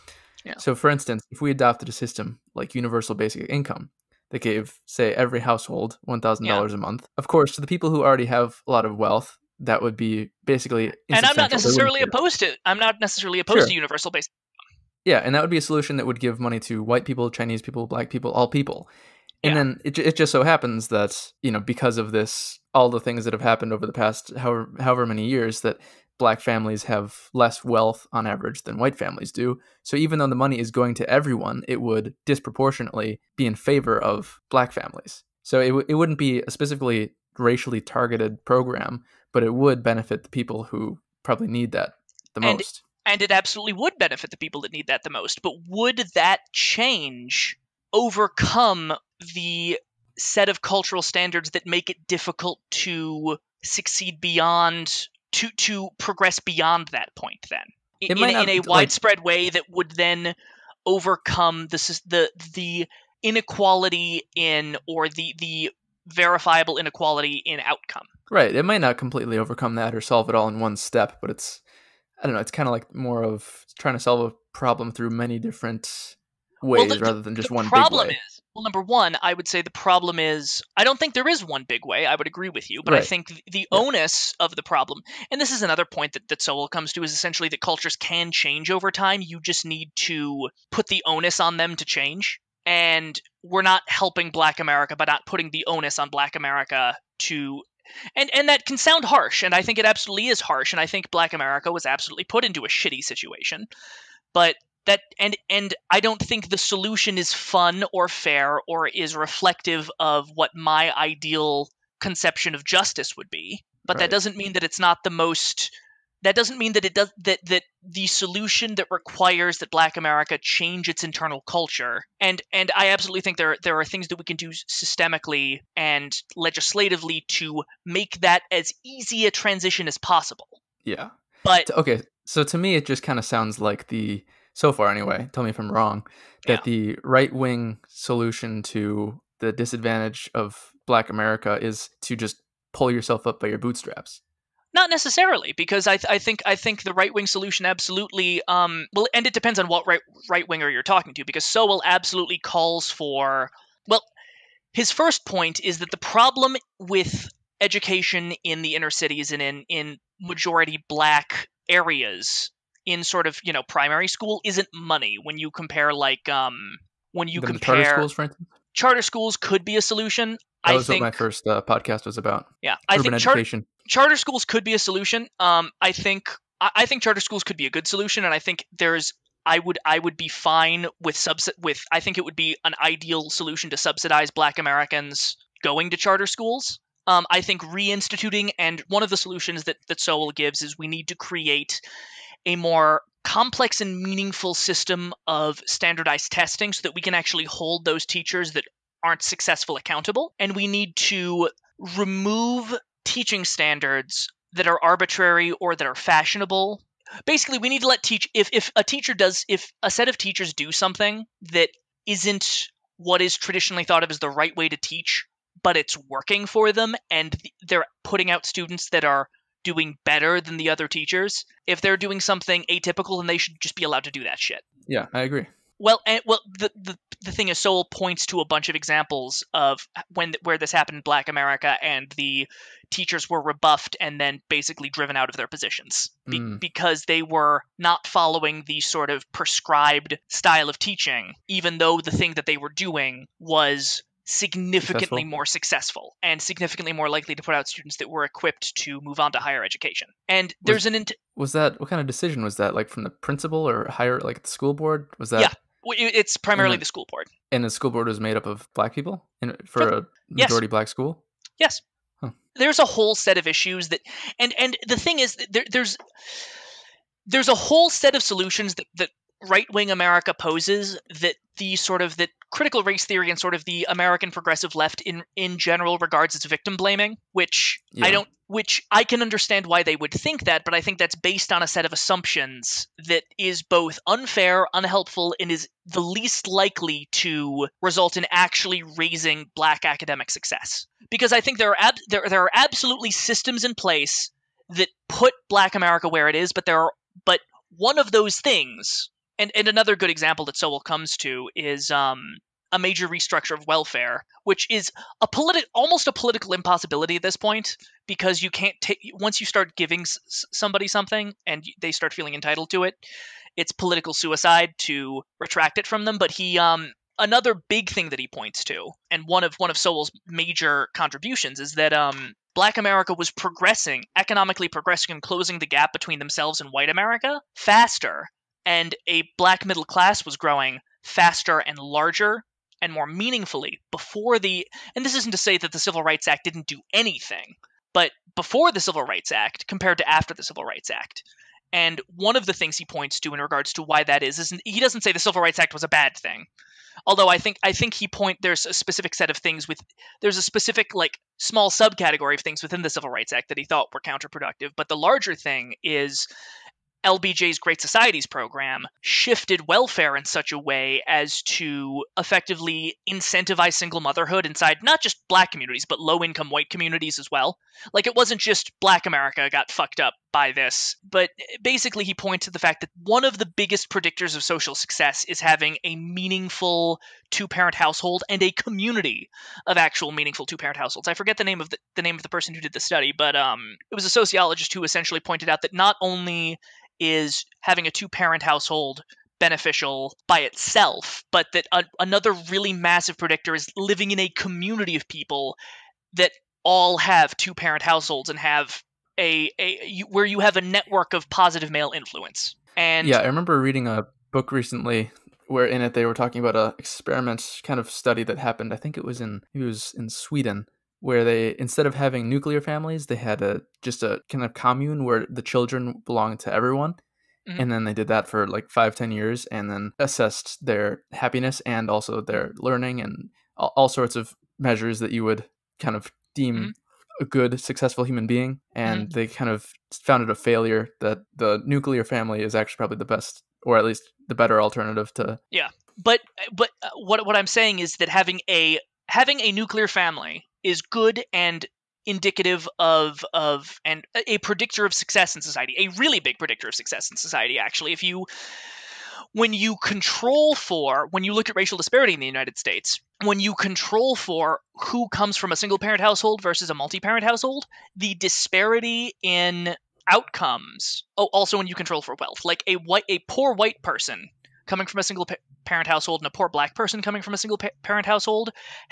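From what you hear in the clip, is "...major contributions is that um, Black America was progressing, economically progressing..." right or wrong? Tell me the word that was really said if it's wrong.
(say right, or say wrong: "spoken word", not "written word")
right.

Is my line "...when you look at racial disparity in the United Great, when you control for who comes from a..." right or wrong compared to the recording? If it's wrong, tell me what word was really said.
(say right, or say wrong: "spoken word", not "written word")
wrong: "States", not "Great".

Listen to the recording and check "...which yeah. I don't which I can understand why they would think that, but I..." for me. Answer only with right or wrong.
right.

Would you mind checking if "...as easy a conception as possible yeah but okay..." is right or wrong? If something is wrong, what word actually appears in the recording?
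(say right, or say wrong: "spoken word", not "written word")
wrong: "transition", not "conception".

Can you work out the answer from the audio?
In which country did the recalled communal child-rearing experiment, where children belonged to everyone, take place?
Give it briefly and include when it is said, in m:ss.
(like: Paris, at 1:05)
Sweden, at 6:50.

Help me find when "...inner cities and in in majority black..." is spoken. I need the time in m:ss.
2:38.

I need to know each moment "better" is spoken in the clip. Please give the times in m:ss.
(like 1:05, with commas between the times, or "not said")
3:40, 7:14.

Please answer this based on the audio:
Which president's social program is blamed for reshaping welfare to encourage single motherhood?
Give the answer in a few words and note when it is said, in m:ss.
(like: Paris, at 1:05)
LBJ, at 5:57.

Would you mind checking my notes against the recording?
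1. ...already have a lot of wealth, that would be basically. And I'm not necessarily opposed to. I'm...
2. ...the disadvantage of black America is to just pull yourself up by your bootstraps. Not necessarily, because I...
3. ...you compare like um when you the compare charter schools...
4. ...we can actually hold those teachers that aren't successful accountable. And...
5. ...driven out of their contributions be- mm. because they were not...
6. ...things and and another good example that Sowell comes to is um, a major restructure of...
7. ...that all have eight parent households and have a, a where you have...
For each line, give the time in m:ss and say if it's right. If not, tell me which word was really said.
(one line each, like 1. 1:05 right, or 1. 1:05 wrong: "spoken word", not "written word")
1. 0:08 right
2. 2:19 right
3. 2:45 right
4. 3:16 right
5. 3:54 wrong: "positions", not "contributions"
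6. 4:58 right
7. 6:36 wrong: "two", not "eight".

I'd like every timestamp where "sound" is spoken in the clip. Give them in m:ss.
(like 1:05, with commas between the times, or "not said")
1:38, 2:13.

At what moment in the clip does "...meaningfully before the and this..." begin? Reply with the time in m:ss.
5:33.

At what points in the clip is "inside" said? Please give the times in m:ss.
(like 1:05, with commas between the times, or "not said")
6:04.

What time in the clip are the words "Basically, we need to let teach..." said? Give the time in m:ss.
3:27.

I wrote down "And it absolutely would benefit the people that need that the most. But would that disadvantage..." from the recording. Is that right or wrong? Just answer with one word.
wrong.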